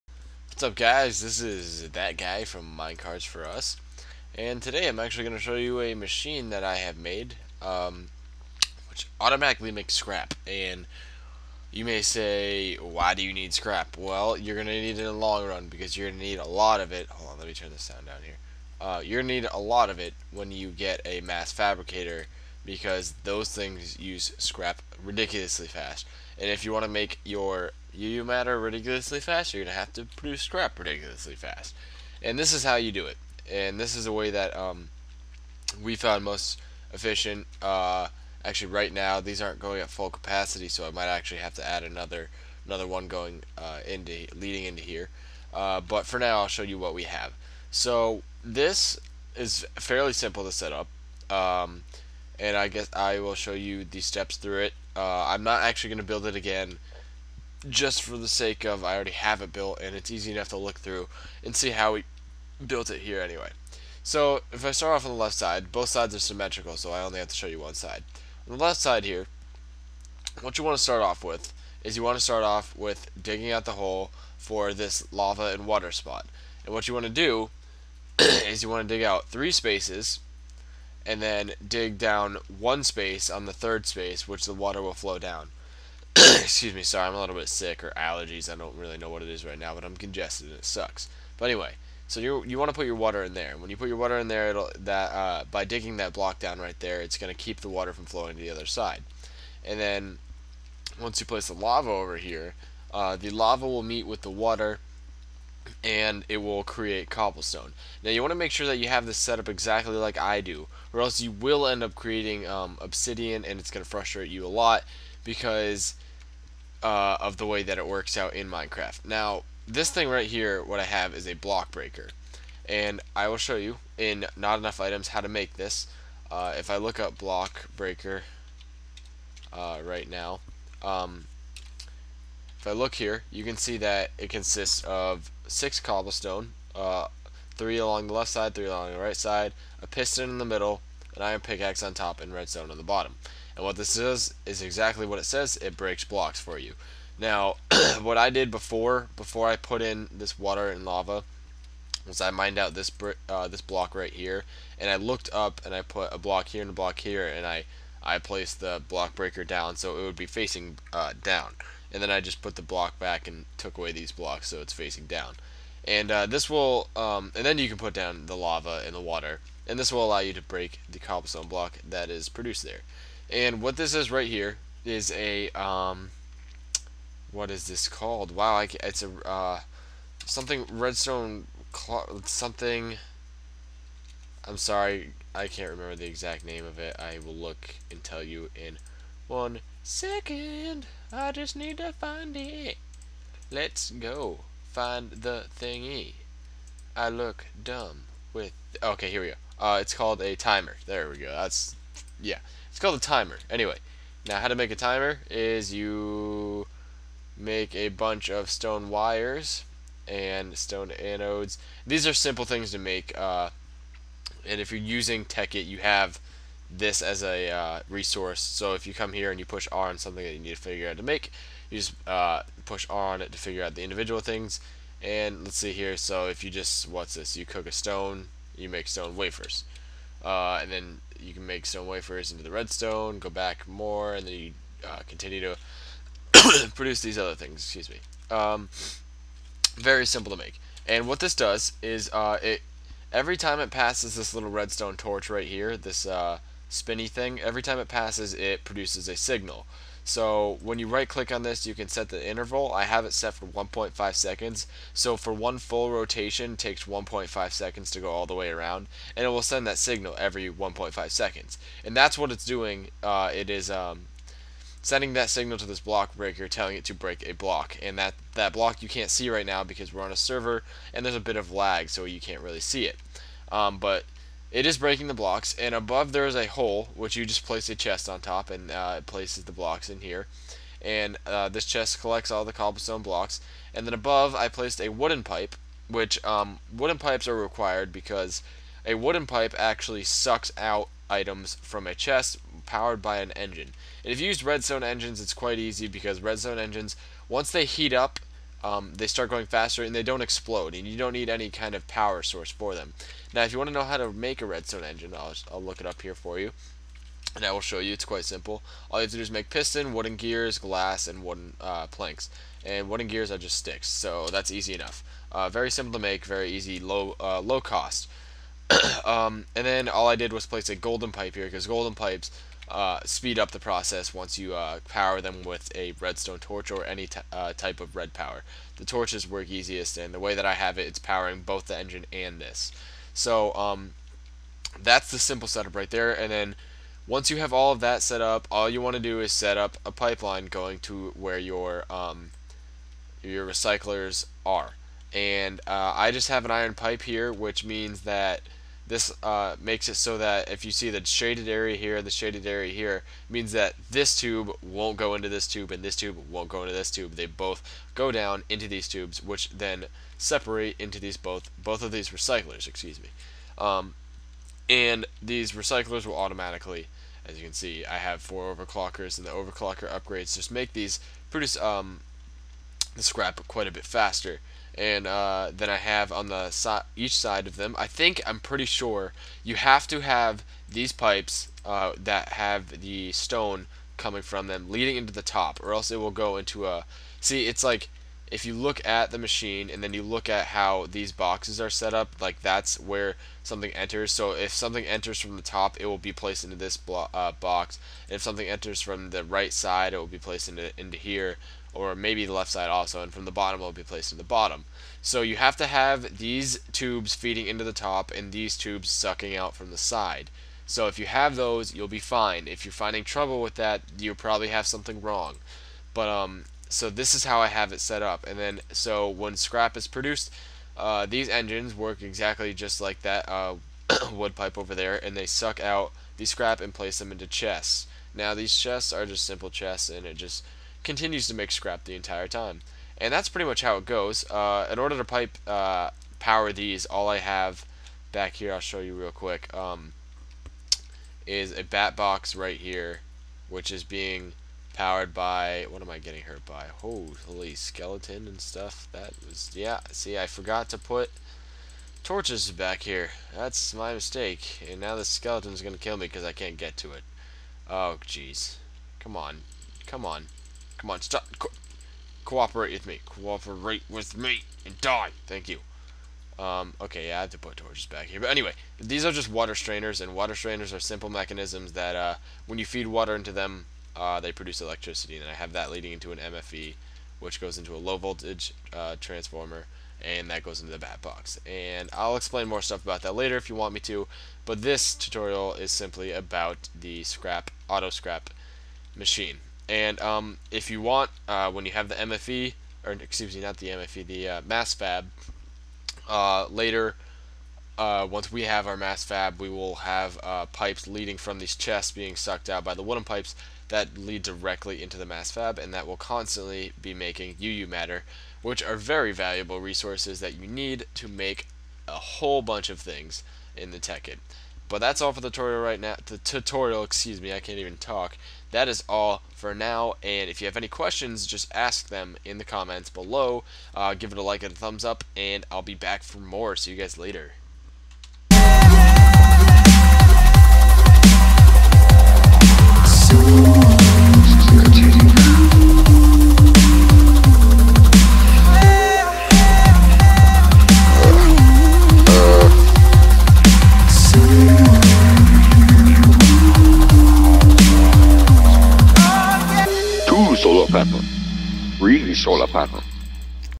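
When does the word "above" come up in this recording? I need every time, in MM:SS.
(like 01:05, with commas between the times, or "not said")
04:35, 04:43.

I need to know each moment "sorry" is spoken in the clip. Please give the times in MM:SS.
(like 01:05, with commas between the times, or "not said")
01:26, 03:04.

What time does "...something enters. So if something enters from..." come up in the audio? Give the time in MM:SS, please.
06:33.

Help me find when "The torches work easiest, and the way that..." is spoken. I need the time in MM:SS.
05:28.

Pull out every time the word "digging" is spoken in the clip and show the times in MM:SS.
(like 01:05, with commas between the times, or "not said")
01:13, 01:35.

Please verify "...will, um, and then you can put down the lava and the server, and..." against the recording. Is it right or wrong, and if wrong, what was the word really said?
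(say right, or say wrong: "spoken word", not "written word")
wrong: "water", not "server".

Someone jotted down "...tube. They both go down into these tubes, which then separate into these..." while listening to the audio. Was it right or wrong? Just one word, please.
right.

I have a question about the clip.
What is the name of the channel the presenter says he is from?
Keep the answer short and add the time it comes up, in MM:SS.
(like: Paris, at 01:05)
Minecarts For Us, at 00:02.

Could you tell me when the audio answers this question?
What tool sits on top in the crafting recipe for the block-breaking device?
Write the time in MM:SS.
02:21.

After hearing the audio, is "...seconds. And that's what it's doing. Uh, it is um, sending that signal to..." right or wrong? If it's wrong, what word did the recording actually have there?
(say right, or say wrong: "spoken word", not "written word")
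right.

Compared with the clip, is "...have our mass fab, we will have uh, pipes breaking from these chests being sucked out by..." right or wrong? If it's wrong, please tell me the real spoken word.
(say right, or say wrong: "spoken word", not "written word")
wrong: "leading", not "breaking".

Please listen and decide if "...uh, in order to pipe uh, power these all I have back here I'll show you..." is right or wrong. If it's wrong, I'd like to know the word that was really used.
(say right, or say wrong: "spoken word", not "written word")
right.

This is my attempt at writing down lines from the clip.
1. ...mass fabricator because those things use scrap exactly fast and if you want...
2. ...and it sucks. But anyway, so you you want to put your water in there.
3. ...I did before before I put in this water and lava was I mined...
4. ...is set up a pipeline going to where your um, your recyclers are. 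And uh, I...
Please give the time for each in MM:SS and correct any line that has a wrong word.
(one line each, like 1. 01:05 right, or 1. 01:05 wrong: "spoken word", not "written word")
1. 00:21 wrong: "ridiculously", not "exactly"
2. 01:30 right
3. 02:28 right
4. 05:39 right.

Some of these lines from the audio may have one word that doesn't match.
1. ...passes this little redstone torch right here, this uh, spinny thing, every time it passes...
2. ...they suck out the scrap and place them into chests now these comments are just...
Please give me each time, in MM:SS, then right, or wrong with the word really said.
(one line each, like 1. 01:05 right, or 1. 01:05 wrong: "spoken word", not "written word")
1. 04:03 right
2. 07:05 wrong: "chests", not "comments".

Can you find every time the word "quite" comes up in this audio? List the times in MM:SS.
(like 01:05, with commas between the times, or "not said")
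04:55, 05:08, 06:13.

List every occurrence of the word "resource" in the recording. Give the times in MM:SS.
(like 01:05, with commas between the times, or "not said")
03:37, 08:29.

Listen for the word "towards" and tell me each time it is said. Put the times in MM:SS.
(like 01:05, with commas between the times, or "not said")
not said.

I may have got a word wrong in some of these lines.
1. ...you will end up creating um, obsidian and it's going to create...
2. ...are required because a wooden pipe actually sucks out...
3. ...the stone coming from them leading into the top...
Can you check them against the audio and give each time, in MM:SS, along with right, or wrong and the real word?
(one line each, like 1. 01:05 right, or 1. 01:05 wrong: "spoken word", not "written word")
1. 01:51 wrong: "frustrate", not "create"
2. 04:47 right
3. 06:22 right.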